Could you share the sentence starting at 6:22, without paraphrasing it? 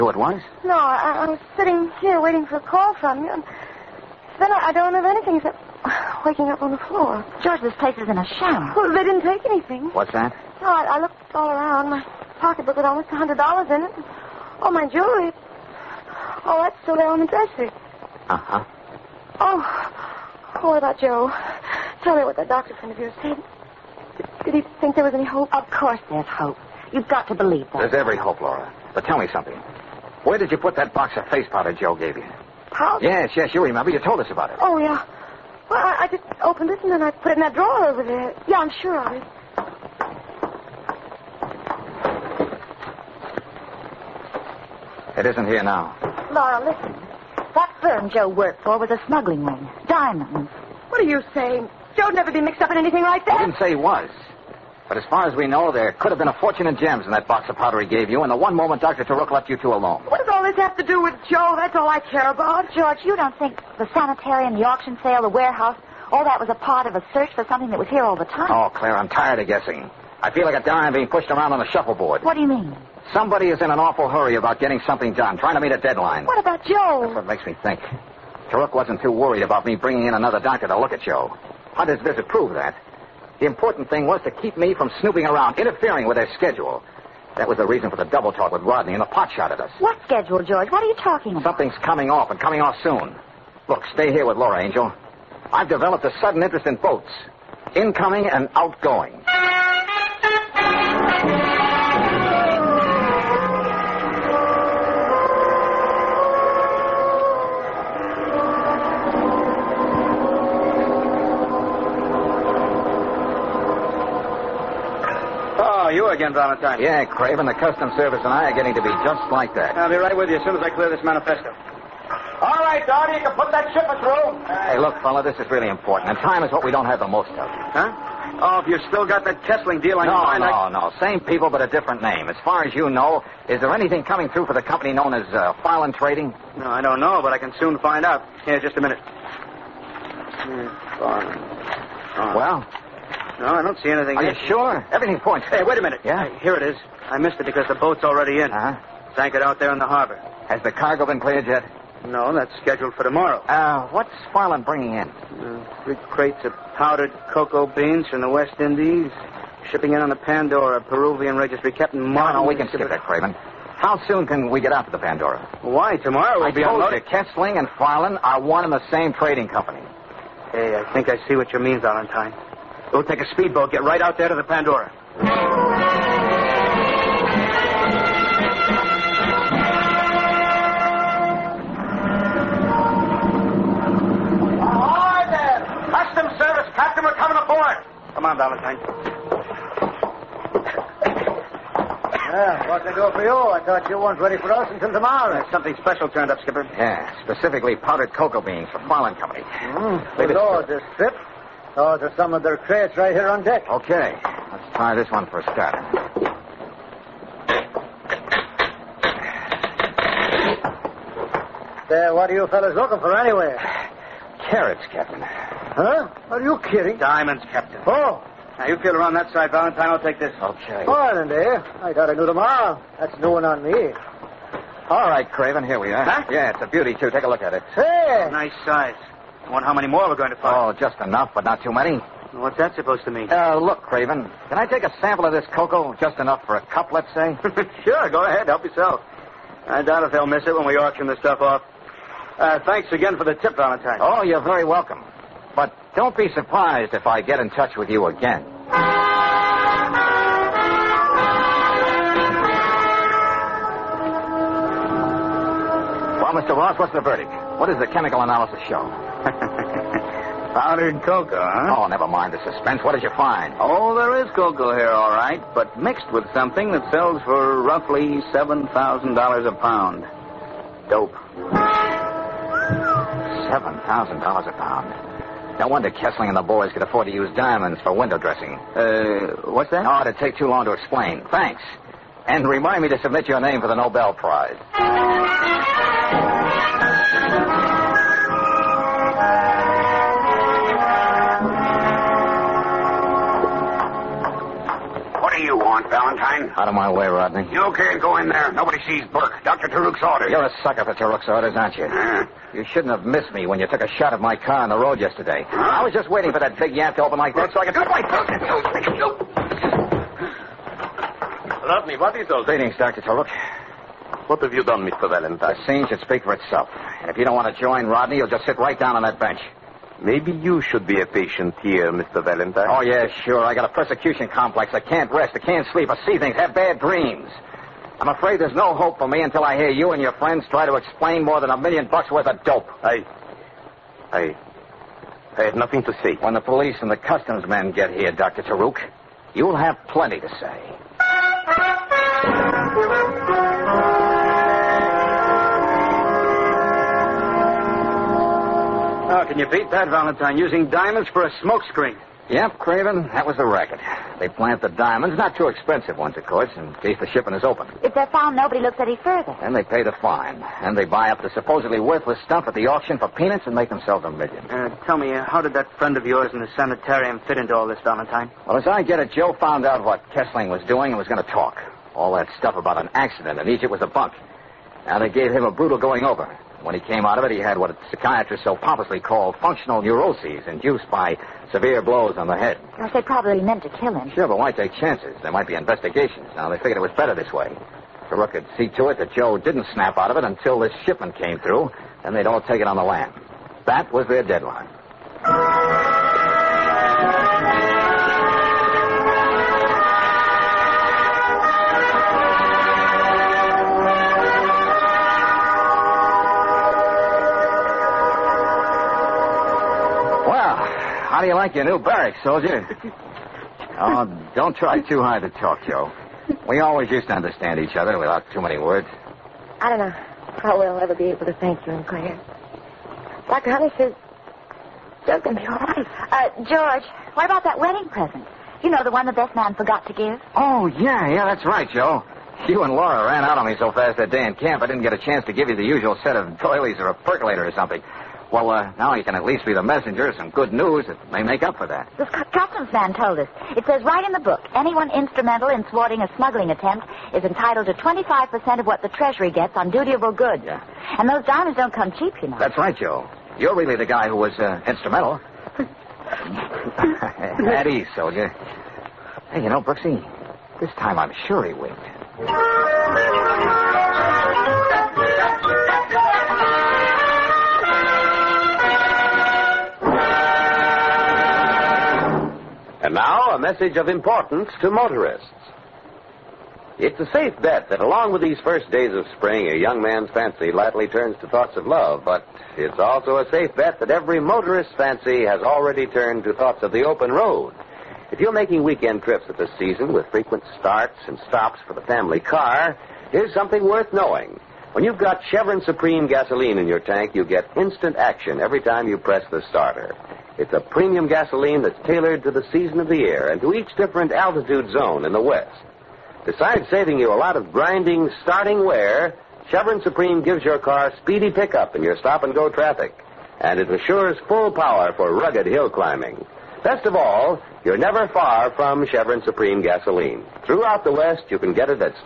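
Gosh, they probably meant to kill him.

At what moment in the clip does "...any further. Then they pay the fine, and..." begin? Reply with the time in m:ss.
5:58.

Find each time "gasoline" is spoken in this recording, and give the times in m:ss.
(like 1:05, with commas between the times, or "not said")
8:16, 8:21, 8:39.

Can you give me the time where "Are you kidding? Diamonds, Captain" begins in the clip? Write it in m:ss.
3:36.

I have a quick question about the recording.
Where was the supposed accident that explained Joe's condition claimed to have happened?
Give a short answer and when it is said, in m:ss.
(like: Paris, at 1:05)
Egypt, at 6:13.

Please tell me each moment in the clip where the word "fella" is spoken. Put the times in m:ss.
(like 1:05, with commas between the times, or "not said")
2:05, 3:32.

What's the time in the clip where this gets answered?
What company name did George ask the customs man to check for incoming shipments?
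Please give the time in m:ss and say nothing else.
2:15.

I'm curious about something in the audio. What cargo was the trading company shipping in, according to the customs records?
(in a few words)
powdered cocoa beans.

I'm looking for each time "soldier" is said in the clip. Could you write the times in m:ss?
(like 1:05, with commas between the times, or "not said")
6:52, 7:37.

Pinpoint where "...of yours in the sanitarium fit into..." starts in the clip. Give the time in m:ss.
6:05.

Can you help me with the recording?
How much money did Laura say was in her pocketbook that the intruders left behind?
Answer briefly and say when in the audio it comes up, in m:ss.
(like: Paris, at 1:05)
almost $100, at 0:12.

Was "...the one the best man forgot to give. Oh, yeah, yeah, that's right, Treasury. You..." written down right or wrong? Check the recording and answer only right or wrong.
wrong.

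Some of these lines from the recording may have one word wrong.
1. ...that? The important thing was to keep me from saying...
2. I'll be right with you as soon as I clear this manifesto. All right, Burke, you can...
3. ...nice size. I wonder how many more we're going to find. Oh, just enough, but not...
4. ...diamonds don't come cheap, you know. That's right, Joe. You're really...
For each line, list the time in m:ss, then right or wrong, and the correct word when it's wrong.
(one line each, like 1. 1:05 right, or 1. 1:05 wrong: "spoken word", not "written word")
1. 1:22 wrong: "snooping", not "saying"
2. 1:59 wrong: "Don", not "Burke"
3. 3:48 right
4. 7:31 right.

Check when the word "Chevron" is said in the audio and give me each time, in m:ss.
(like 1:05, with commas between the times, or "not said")
8:15, 8:29, 8:38.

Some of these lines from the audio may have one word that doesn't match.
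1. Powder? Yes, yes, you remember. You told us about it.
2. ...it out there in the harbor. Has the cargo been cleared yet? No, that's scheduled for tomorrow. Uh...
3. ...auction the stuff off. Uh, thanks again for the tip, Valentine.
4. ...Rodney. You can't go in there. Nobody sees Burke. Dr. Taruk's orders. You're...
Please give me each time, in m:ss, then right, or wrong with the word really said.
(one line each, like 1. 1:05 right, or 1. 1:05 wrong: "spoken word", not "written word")
1. 0:32 right
2. 2:29 right
3. 4:00 right
4. 4:57 right.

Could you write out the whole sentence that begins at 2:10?
no, same people but a different name.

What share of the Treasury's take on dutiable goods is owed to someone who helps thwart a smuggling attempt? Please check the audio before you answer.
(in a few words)
25%.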